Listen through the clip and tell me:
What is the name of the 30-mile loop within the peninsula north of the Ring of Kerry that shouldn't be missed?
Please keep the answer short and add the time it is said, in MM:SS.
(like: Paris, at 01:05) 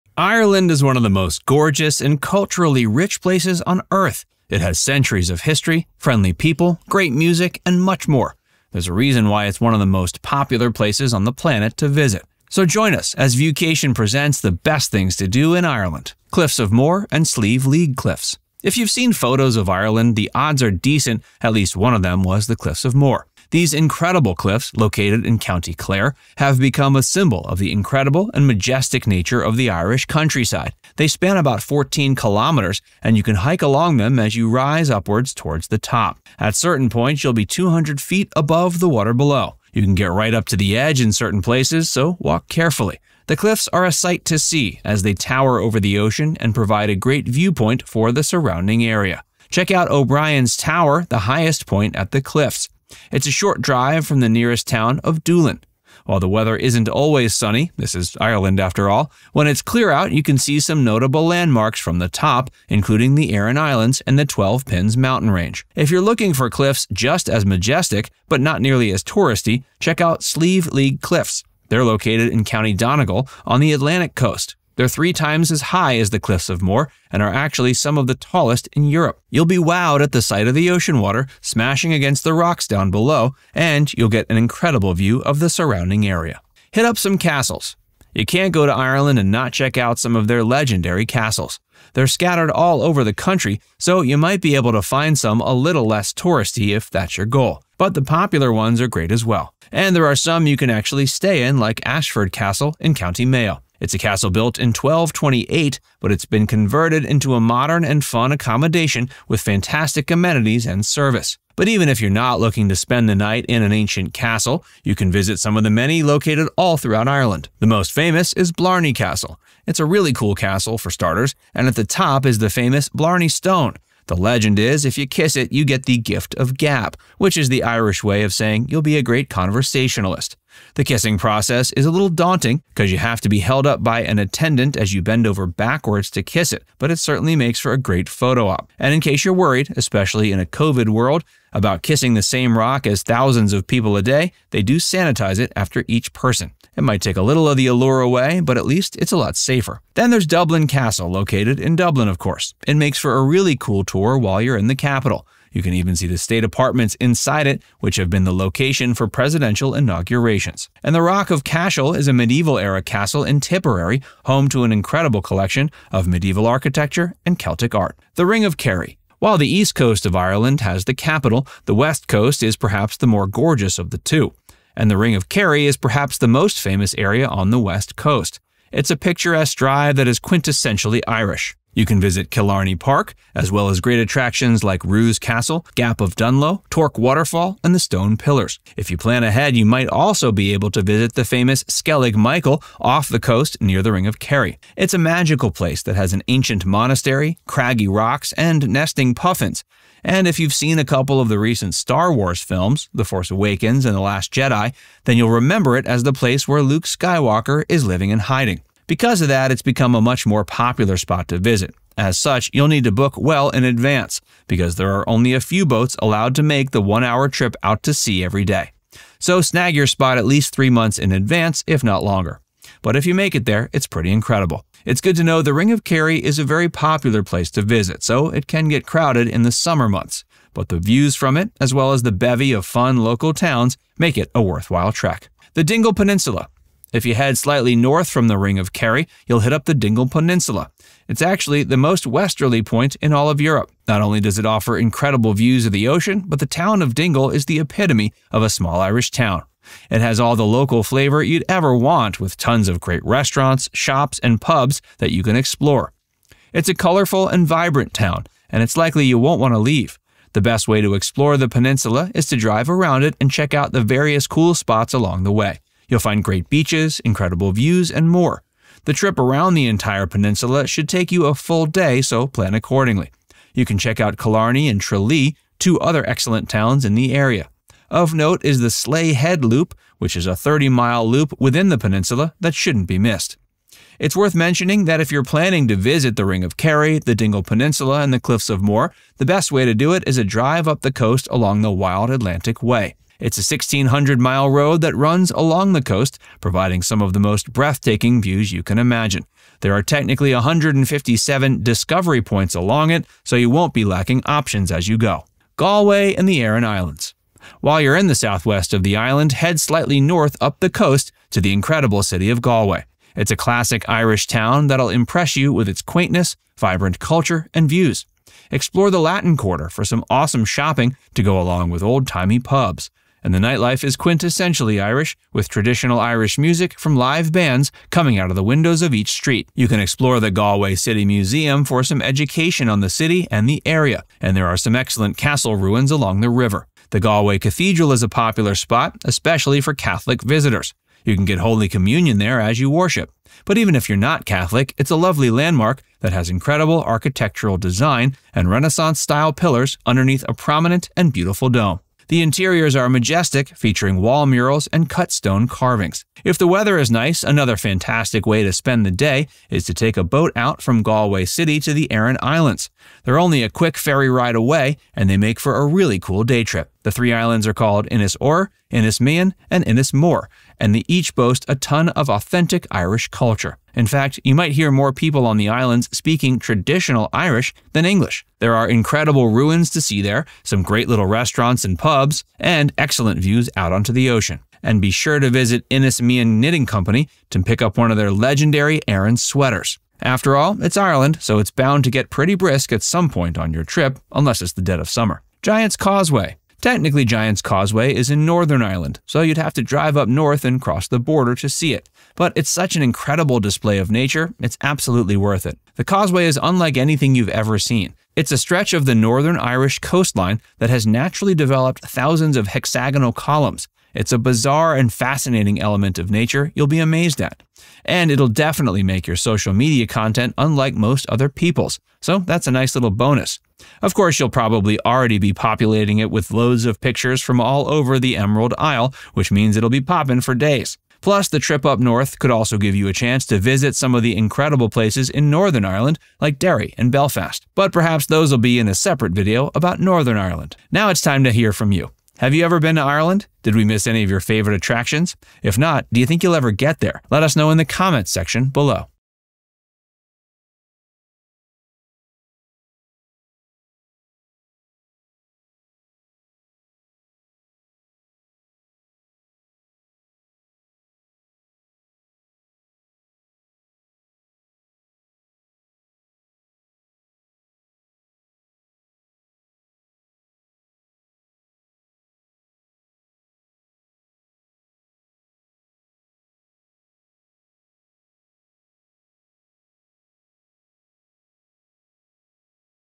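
Slea Head Loop, at 04:38.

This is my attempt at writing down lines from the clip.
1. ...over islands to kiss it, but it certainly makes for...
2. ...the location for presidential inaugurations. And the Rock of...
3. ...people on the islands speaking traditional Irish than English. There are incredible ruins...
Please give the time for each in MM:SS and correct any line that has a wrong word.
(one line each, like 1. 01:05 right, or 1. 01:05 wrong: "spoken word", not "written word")
1. 02:15 wrong: "backwards", not "islands"
2. 02:38 right
3. 06:14 right.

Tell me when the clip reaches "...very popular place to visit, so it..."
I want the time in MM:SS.
03:46.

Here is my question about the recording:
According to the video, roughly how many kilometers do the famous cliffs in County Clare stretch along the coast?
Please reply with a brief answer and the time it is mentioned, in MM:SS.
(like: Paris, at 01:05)
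14 kilometers, at 00:31.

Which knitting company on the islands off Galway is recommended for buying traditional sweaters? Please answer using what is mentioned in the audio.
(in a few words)
Mian Knitting Company.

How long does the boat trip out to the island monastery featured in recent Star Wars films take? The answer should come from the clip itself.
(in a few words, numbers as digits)
One hour.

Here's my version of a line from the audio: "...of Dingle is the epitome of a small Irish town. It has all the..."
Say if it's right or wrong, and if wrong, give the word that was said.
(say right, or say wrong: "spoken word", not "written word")
right.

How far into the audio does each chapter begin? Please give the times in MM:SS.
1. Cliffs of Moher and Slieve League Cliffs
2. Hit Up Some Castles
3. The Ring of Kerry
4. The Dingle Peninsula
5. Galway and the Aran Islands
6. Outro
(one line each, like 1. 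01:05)
1. 00:16
2. 01:26
3. 02:48
4. 03:55
5. 05:05
6. 07:20.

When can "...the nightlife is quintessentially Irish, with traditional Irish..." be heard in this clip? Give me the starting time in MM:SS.
05:23.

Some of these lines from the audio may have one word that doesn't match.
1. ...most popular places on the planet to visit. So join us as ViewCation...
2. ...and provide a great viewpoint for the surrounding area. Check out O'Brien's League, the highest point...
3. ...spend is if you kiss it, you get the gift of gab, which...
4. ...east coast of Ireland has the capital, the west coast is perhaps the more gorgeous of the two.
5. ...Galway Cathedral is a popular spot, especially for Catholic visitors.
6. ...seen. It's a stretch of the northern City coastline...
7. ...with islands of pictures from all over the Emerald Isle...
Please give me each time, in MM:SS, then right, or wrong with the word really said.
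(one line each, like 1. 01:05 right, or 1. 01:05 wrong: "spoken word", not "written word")
1. 00:09 right
2. 00:46 wrong: "Tower", not "League"
3. 02:04 wrong: "legend", not "spend"
4. 02:49 right
5. 05:36 right
6. 06:47 wrong: "Irish", not "City"
7. 07:06 wrong: "loads", not "islands".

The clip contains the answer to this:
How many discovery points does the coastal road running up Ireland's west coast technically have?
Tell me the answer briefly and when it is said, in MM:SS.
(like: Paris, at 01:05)
157, at 05:00.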